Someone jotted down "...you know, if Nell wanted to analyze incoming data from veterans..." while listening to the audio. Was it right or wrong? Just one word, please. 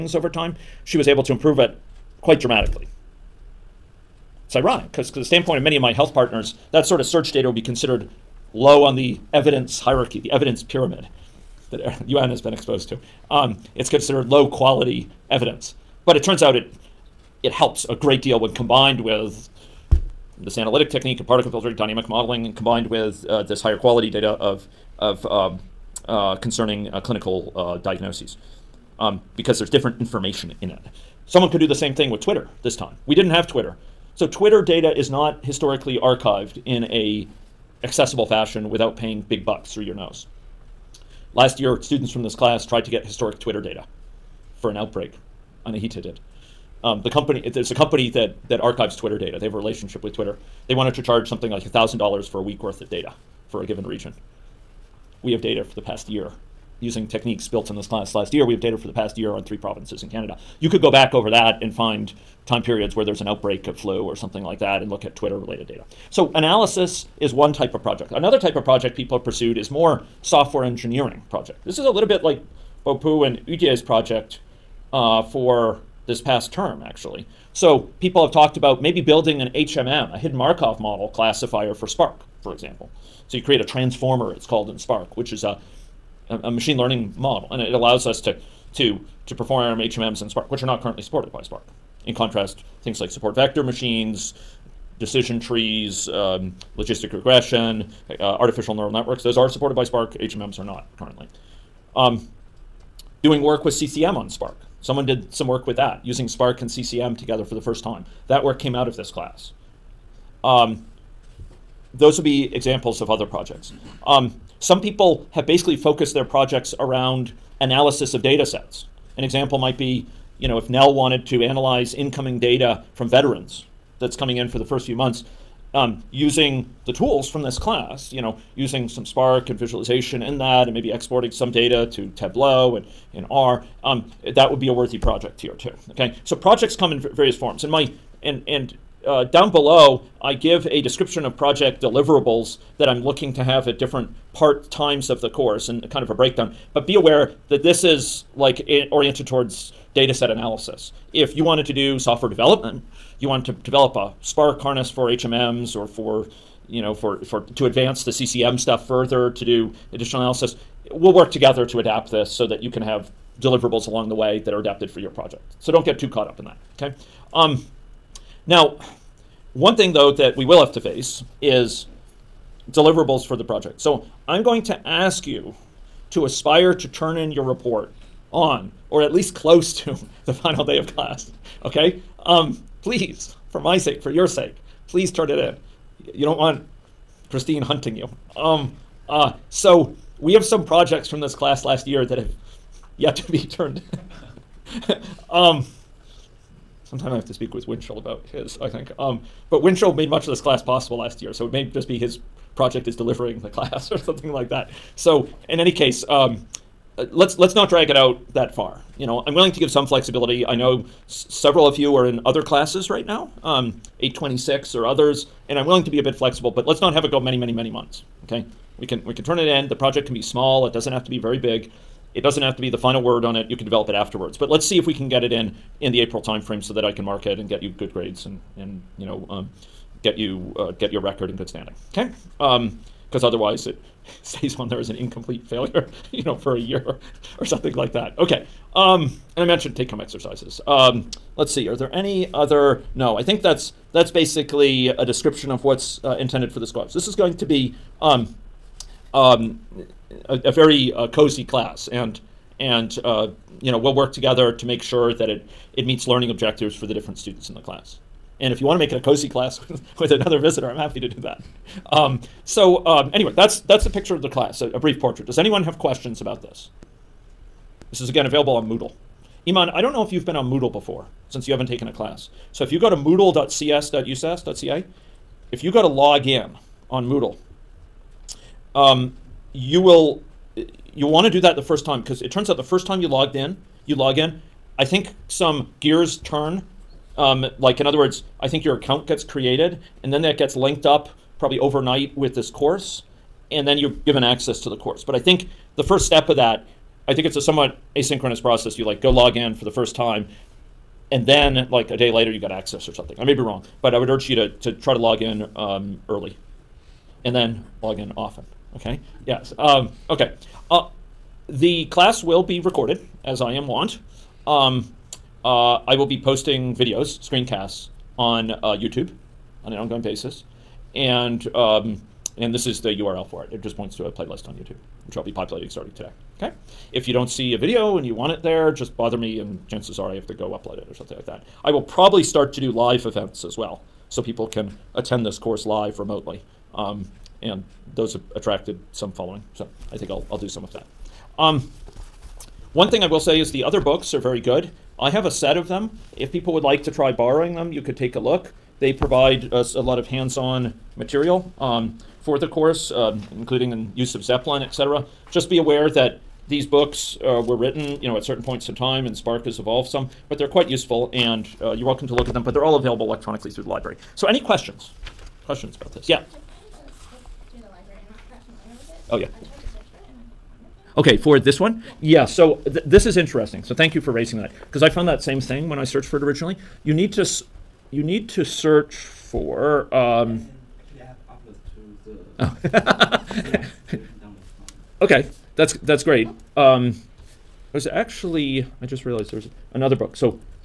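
right.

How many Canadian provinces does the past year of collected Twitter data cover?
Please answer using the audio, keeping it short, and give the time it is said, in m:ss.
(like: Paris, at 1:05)
3, at 0:59.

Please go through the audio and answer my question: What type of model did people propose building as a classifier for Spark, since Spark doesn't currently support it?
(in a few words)
hidden Markov model.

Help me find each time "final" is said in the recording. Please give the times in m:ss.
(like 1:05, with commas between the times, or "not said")
3:00, 3:42.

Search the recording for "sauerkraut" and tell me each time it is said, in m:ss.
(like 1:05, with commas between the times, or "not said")
not said.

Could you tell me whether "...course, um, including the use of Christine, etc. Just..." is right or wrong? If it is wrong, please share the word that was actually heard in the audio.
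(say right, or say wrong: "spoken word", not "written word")
wrong: "Zeppelin", not "Christine".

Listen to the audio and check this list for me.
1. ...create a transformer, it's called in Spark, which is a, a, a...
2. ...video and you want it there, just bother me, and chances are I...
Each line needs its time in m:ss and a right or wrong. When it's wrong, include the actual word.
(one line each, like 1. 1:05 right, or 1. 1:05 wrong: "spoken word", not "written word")
1. 1:23 right
2. 5:27 right.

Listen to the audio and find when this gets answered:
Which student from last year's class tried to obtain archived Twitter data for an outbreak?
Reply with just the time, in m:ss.
0:45.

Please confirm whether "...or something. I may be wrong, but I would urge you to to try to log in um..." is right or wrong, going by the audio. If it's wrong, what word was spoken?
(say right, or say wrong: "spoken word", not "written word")
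right.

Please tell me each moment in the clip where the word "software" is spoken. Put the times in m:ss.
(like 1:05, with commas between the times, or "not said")
1:10, 2:31.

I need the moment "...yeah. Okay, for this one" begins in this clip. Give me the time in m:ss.
6:09.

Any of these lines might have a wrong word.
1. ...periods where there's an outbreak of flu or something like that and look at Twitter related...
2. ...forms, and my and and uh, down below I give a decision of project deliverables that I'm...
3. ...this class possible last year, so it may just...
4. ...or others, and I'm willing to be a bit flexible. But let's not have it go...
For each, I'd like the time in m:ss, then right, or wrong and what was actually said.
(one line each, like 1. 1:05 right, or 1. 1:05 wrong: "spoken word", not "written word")
1. 1:02 right
2. 2:17 wrong: "description", not "decision"
3. 3:20 right
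4. 3:34 right.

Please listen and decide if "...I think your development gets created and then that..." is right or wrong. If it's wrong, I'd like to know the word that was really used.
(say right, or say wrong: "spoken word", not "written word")
wrong: "account", not "development".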